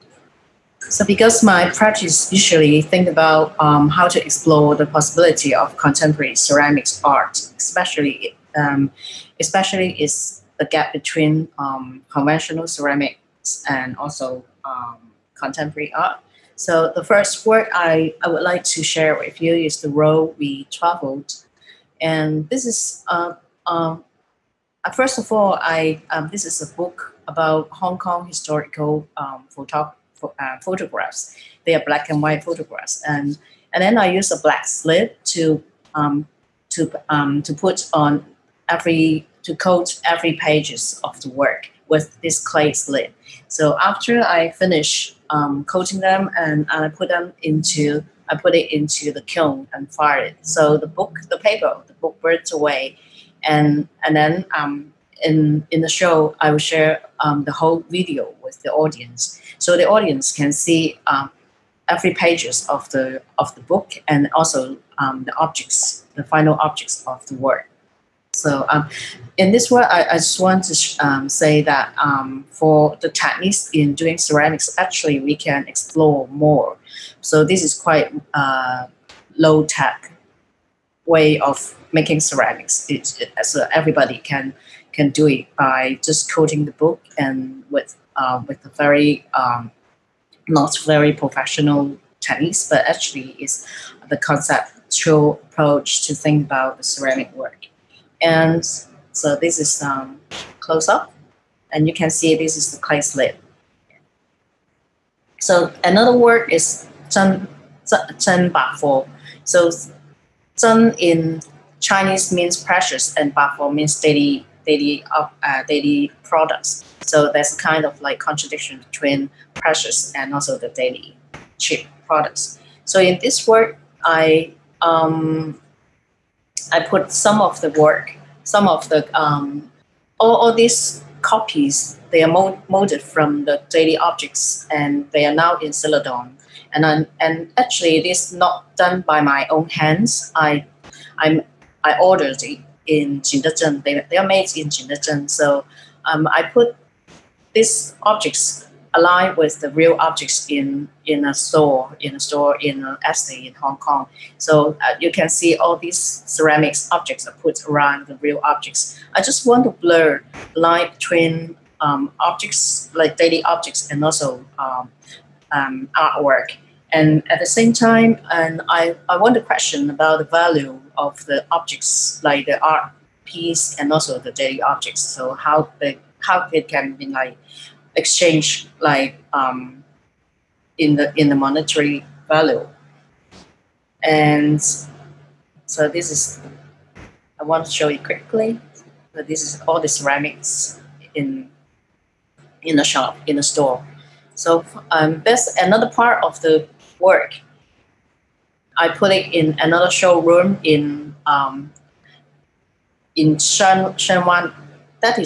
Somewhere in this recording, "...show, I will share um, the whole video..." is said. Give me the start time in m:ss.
0:55.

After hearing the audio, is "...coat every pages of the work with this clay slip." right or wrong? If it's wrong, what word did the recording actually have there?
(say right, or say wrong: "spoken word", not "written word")
right.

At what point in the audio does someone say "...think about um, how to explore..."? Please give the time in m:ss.
0:02.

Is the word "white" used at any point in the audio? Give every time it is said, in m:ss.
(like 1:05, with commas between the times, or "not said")
0:32.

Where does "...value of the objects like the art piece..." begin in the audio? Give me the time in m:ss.
2:50.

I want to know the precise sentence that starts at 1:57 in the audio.
So there's kind of like contradiction between precious and also the daily cheap products.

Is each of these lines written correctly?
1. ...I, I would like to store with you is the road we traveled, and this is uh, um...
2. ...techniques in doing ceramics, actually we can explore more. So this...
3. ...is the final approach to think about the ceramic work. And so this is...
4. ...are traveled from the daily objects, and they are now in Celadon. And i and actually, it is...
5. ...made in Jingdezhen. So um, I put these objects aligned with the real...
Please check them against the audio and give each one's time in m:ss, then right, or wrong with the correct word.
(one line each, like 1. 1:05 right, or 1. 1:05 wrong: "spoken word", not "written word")
1. 0:17 wrong: "share", not "store"
2. 1:13 right
3. 1:33 wrong: "conceptual", not "final"
4. 2:12 wrong: "molded", not "traveled"
5. 2:24 right.